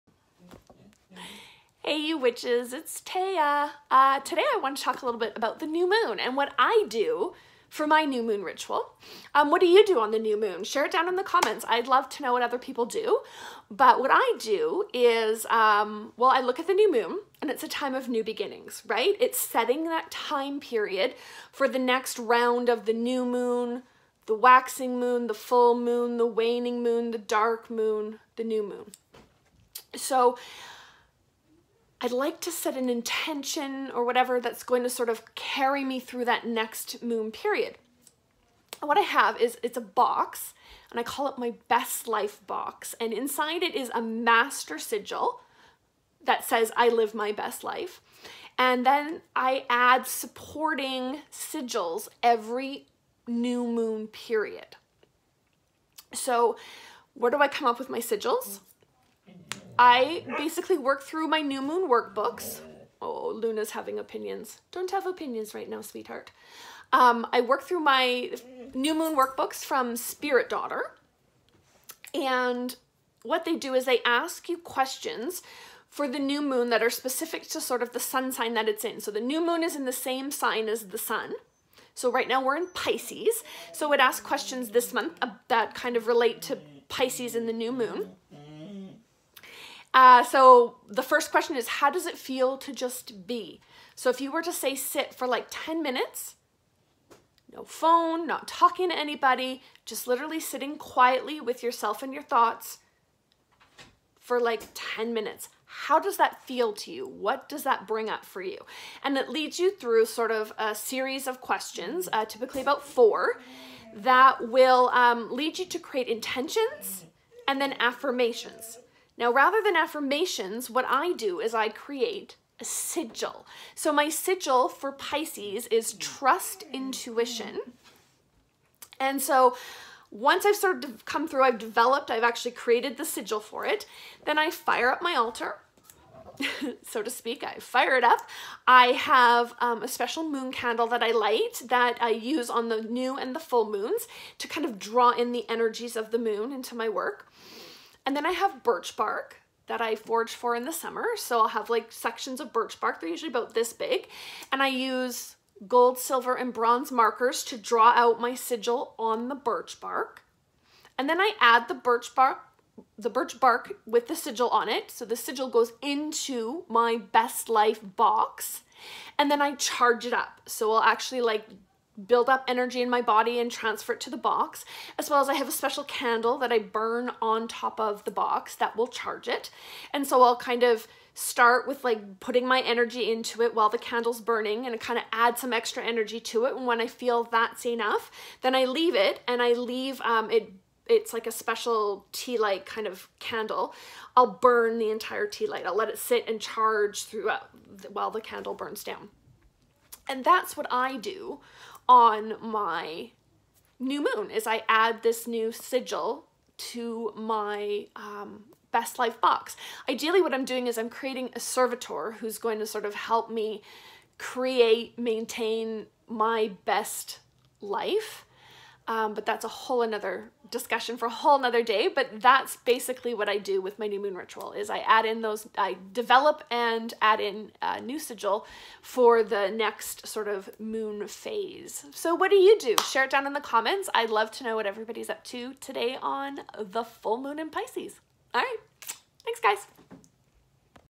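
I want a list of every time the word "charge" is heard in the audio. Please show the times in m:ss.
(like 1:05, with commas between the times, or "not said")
2:49, 2:58, 3:16.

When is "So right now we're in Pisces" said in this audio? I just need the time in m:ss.
1:21.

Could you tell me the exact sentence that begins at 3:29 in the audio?
Ideally what I'm doing is I'm creating a servitor who's going to sort of help me create, maintain my best life.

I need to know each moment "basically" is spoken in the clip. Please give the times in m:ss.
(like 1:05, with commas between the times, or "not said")
1:00, 3:42.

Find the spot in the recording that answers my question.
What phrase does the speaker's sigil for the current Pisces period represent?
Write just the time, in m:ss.
2:05.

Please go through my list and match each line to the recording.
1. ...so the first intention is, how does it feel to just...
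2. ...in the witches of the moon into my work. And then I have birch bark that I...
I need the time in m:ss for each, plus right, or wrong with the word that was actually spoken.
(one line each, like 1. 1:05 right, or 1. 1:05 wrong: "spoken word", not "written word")
1. 1:30 wrong: "question", not "intention"
2. 2:25 wrong: "energies", not "witches".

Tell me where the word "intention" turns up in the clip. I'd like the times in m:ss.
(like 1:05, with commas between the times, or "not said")
0:32, 1:56.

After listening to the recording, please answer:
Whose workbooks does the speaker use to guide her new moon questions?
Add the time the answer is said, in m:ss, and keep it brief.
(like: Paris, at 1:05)
Spirit Daughter, at 1:09.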